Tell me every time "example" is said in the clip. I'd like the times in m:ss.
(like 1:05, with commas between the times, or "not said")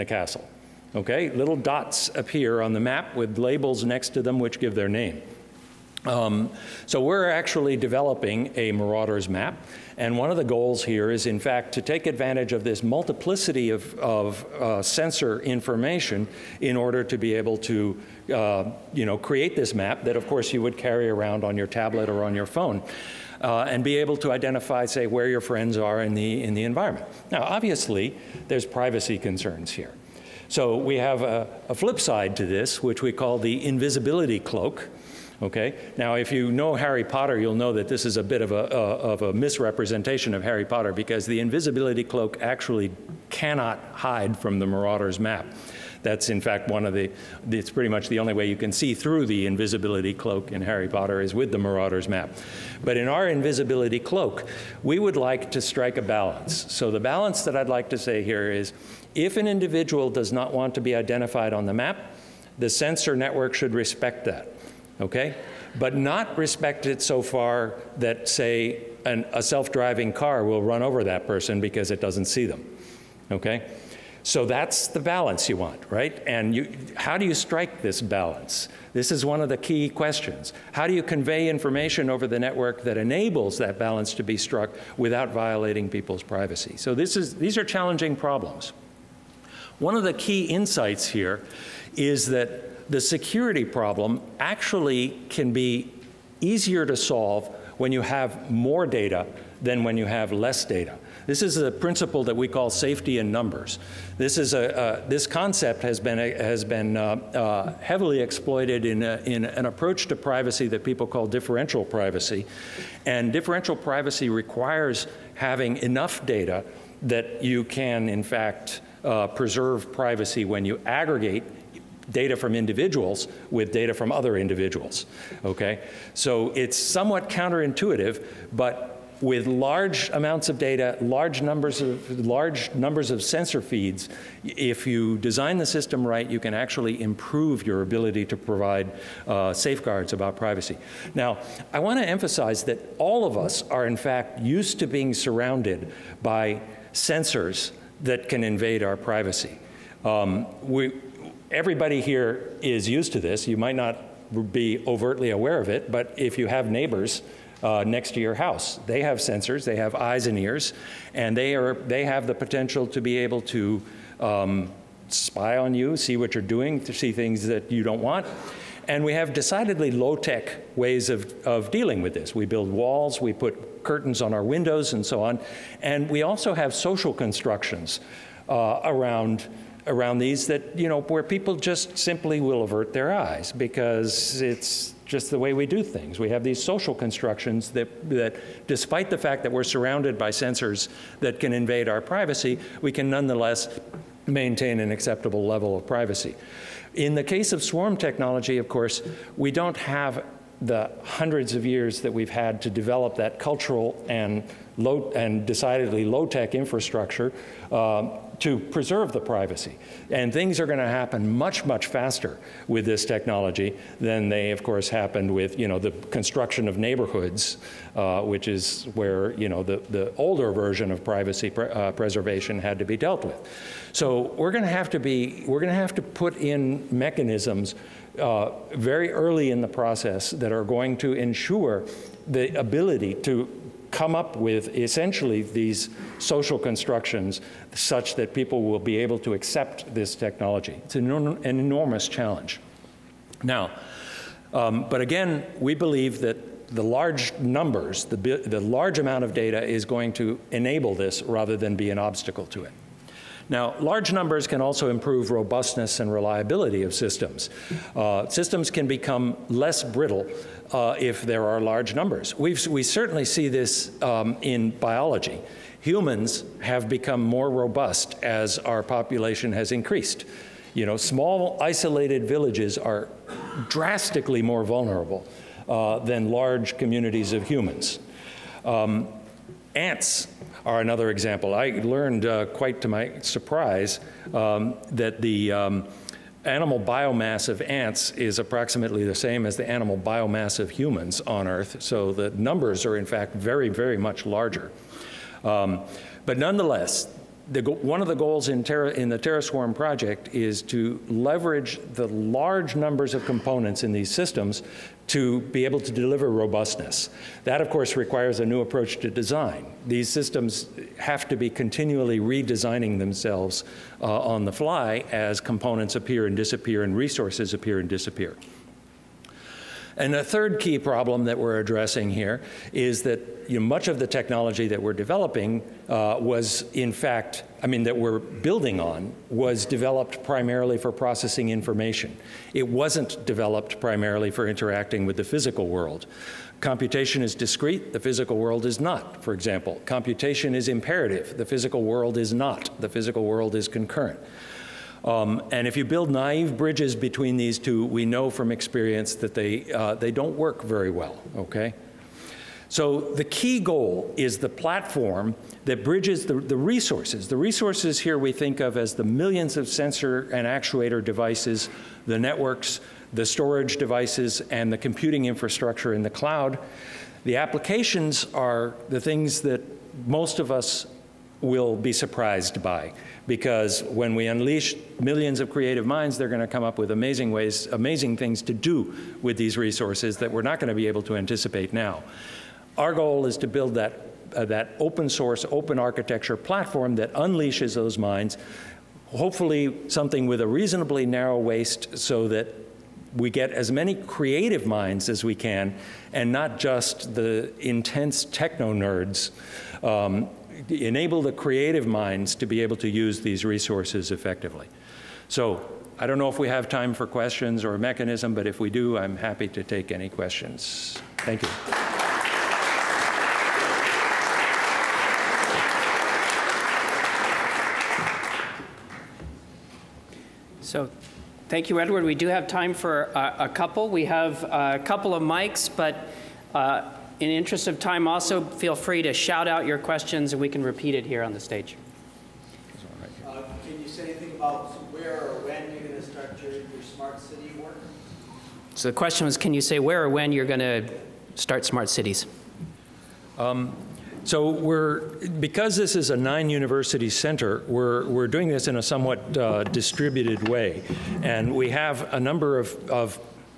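4:41, 5:39.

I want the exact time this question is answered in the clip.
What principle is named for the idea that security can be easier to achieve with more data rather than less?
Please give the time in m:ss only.
1:42.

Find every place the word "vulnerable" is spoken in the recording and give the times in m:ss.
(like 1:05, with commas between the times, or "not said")
4:34.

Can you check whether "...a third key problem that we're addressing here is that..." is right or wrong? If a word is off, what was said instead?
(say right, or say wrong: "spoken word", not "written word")
right.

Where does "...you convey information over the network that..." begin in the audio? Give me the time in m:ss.
1:20.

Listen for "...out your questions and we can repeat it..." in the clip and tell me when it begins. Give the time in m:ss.
7:09.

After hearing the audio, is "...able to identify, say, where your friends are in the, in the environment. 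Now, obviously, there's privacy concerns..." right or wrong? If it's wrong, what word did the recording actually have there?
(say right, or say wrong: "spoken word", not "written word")
right.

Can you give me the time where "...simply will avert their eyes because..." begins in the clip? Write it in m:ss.
3:01.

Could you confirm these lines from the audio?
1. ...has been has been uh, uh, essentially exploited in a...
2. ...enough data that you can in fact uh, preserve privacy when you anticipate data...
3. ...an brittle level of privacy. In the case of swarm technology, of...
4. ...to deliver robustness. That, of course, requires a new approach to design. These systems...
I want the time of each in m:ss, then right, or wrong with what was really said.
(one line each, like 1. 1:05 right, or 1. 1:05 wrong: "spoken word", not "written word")
1. 1:45 wrong: "heavily", not "essentially"
2. 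1:55 wrong: "aggregate", not "anticipate"
3. 3:14 wrong: "acceptable", not "brittle"
4. 5:05 right.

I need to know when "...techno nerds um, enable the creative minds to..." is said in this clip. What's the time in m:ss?
6:38.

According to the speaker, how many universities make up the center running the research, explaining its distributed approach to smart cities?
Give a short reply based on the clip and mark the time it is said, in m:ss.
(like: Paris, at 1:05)
9, at 7:26.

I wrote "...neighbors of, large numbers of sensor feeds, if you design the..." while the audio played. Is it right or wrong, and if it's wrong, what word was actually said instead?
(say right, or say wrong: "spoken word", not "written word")
wrong: "numbers", not "neighbors".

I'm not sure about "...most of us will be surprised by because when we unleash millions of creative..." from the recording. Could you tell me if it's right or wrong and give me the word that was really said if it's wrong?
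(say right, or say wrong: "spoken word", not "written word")
right.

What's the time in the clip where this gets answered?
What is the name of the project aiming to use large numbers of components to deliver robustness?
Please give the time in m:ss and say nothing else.
4:59.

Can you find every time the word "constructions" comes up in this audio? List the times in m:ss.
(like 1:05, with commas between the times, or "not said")
2:57, 3:06, 3:36, 3:56.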